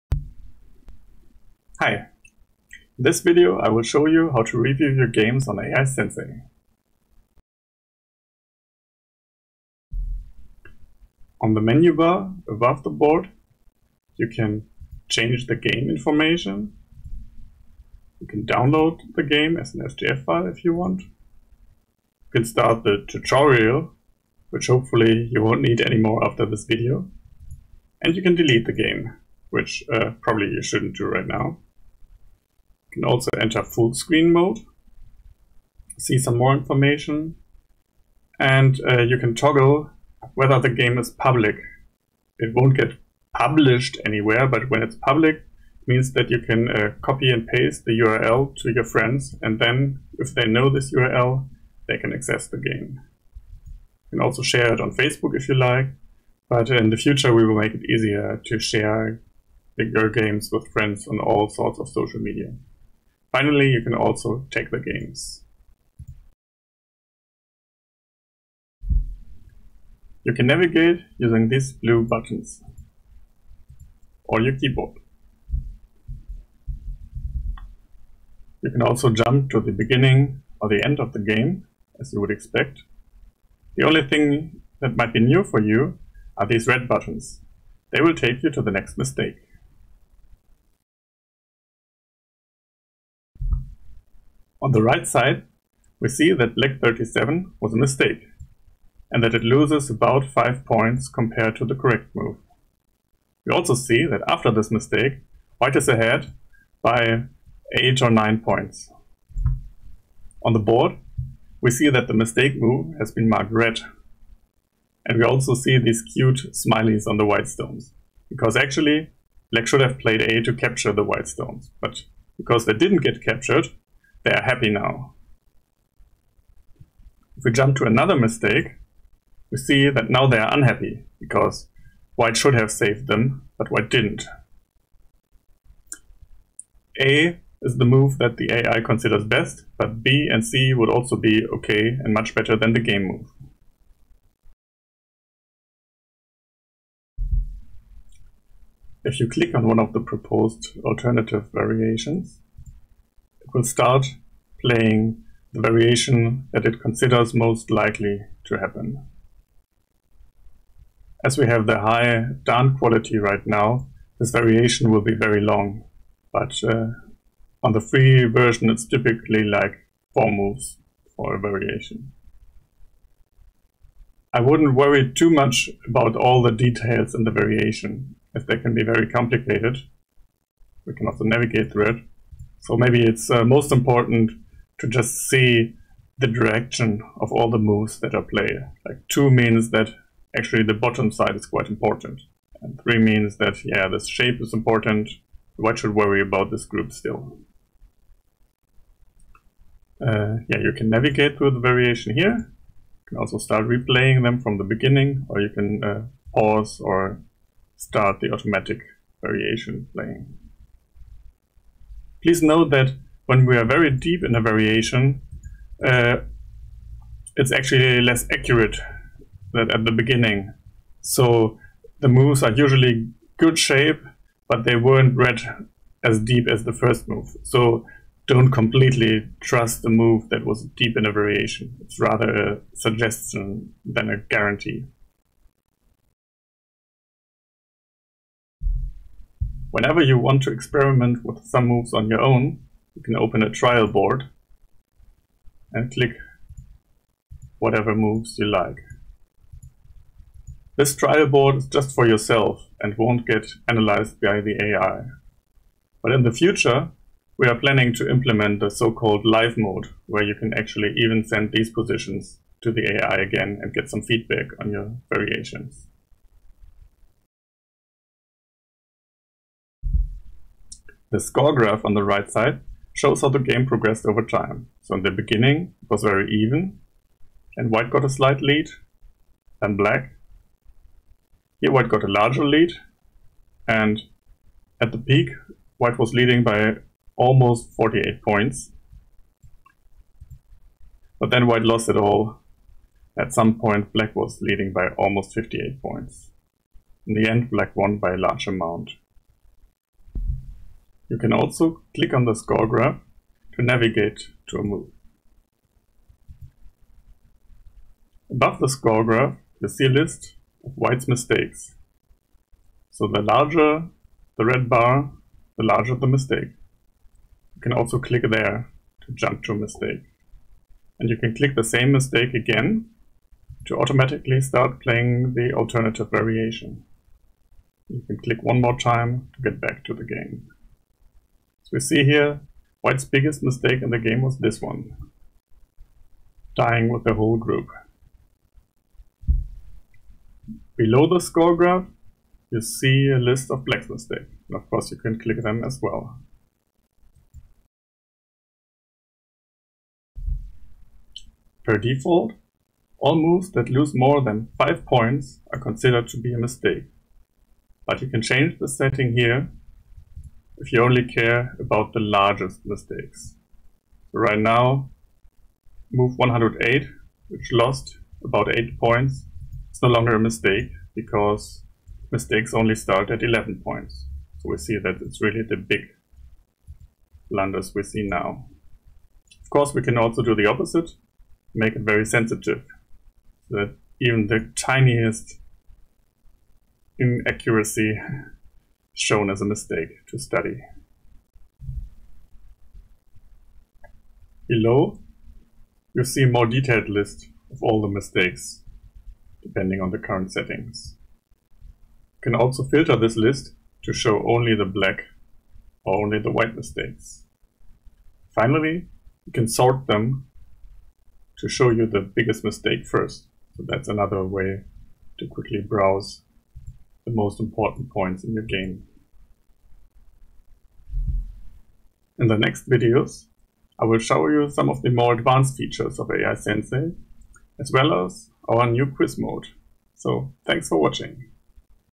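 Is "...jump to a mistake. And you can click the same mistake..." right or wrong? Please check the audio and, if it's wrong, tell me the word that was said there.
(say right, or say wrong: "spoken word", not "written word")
right.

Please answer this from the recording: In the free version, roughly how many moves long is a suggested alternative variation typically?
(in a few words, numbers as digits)
4.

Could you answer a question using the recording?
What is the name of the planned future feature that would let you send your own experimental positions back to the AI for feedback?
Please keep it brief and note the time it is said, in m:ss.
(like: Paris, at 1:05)
live mode, at 4:19.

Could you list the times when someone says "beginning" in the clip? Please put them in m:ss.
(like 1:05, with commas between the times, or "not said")
1:19, 3:24, 3:39, 4:35.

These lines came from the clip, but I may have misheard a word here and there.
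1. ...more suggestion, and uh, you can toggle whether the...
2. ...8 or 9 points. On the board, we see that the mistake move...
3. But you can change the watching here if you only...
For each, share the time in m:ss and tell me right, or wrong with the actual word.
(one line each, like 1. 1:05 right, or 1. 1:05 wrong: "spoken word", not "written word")
1. 0:36 wrong: "information", not "suggestion"
2. 1:47 right
3. 5:57 wrong: "setting", not "watching".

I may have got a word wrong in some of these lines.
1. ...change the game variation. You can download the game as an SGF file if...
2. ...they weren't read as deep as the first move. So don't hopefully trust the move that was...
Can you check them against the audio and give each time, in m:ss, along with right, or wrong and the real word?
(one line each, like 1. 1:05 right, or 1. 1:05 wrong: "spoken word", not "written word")
1. 0:15 wrong: "information", not "variation"
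2. 3:44 wrong: "completely", not "hopefully".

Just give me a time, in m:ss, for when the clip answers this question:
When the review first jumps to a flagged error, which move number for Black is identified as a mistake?
1:36.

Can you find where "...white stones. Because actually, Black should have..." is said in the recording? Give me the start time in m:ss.
1:57.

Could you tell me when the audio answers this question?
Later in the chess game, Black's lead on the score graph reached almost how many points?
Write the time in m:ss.
4:55.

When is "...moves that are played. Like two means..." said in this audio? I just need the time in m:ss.
3:07.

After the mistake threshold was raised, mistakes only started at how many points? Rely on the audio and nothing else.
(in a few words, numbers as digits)
11.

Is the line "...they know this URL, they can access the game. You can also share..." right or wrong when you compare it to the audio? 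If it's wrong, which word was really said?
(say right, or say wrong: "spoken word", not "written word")
right.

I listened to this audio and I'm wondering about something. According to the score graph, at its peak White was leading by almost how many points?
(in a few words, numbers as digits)
48.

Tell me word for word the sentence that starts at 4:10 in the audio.
This trial board is just for yourself and won't get analyzed by the AI.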